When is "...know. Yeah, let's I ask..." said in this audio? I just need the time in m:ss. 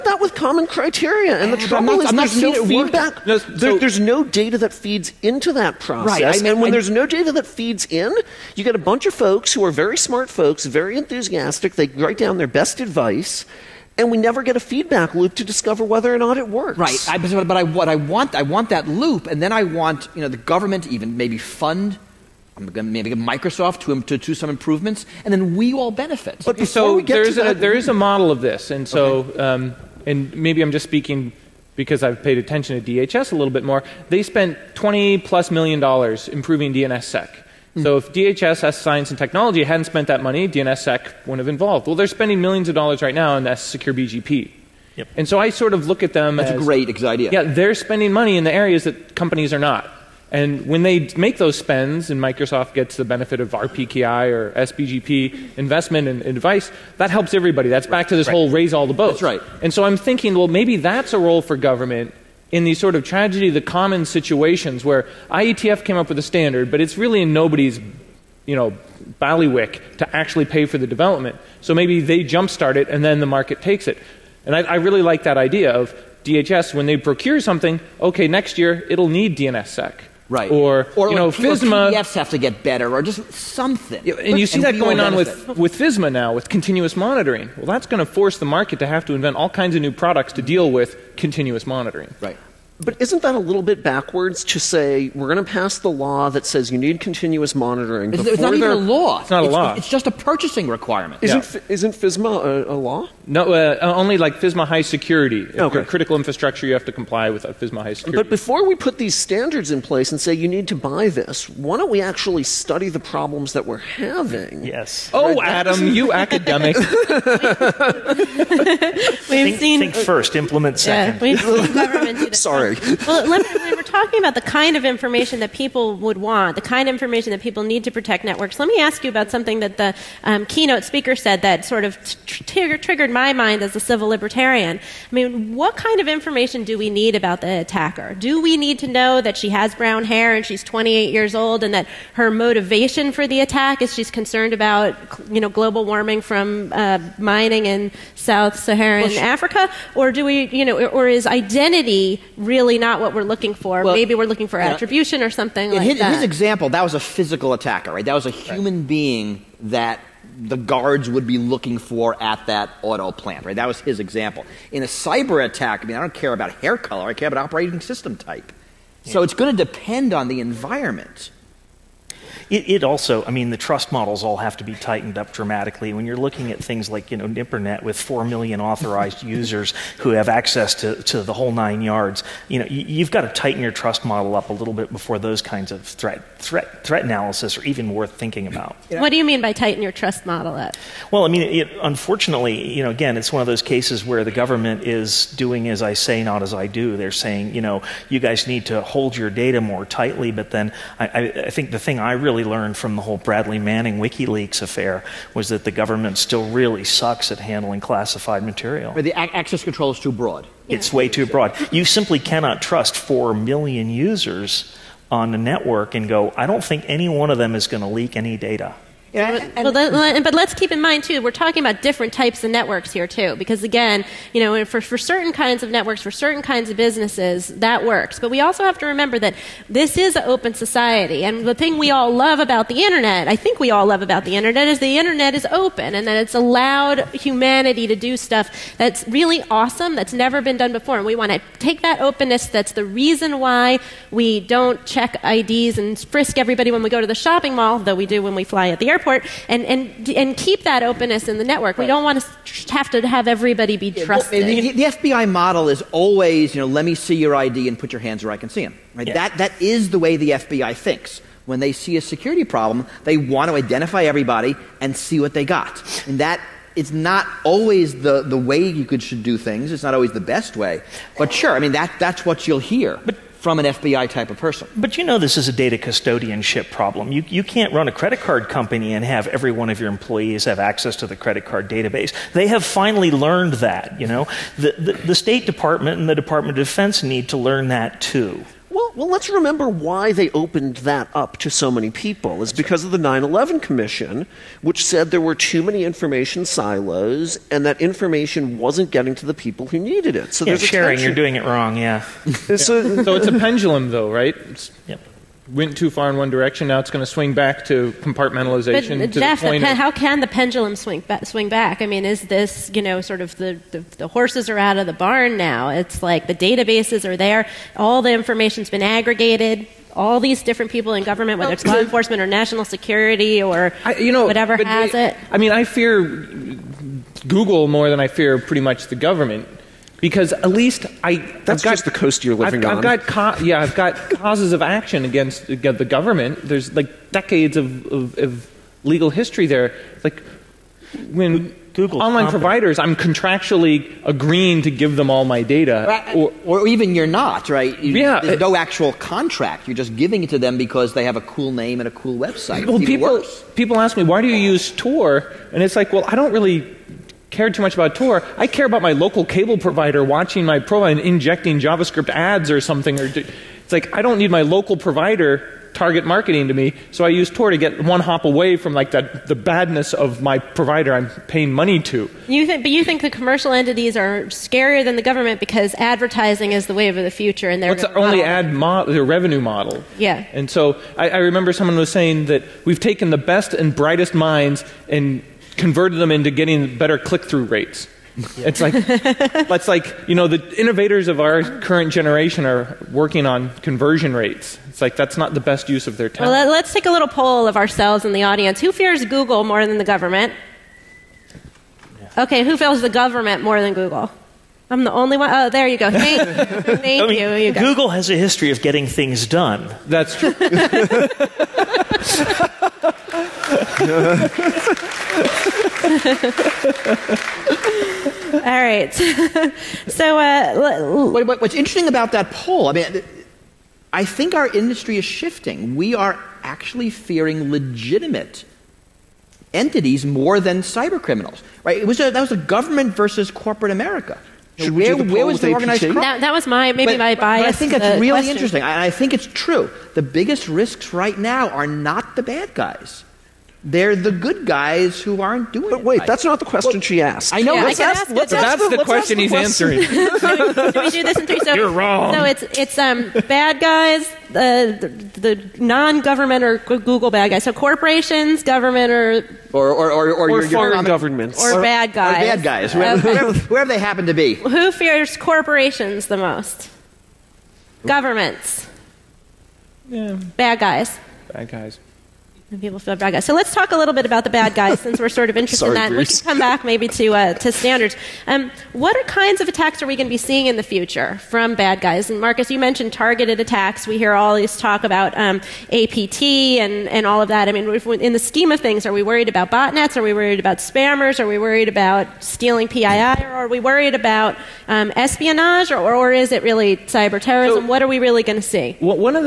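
7:27.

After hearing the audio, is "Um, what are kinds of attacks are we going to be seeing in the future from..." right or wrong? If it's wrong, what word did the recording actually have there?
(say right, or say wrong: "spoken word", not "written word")
right.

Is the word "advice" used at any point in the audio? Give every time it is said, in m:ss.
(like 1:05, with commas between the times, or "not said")
0:12, 0:56.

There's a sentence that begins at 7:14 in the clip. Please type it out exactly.
Should where, we do the where was the organized crime?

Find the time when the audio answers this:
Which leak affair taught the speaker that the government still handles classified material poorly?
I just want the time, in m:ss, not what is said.
3:23.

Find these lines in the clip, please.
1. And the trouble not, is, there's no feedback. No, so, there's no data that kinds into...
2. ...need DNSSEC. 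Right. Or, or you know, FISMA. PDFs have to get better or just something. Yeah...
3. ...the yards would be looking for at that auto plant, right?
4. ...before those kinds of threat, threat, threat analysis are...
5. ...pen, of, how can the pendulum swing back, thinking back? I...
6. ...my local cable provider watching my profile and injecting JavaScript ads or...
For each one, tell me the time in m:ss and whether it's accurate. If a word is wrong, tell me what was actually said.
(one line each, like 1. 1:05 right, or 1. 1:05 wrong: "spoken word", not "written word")
1. 0:01 wrong: "feeds", not "kinds"
2. 1:19 right
3. 2:40 wrong: "guards", not "yards"
4. 3:04 right
5. 5:09 wrong: "swing", not "thinking"
6. 5:58 right.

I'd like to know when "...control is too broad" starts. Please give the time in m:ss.
3:29.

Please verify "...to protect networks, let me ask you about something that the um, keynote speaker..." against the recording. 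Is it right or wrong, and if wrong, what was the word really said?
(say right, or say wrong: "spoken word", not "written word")
right.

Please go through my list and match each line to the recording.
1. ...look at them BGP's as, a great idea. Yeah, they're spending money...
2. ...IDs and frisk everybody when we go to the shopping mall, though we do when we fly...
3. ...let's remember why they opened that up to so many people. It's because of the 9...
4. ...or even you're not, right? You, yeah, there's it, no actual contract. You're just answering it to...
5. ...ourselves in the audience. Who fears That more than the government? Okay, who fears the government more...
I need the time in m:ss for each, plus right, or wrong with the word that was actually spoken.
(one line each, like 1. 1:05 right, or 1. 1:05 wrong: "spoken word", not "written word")
1. 0:45 wrong: "That", not "BGP"
2. 4:05 right
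3. 4:49 right
4. 5:46 wrong: "giving", not "answering"
5. 6:37 wrong: "Google", not "That".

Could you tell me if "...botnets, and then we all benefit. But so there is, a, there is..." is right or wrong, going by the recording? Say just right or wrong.
wrong.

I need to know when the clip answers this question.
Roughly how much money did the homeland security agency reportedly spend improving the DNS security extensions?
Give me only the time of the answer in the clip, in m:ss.
0:34.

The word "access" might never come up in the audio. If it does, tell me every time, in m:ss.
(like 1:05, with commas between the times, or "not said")
3:00, 3:29, 4:40.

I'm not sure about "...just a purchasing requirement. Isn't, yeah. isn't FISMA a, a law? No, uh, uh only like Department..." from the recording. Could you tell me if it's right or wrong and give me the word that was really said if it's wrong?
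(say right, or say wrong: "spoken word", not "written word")
wrong: "FISMA", not "Department".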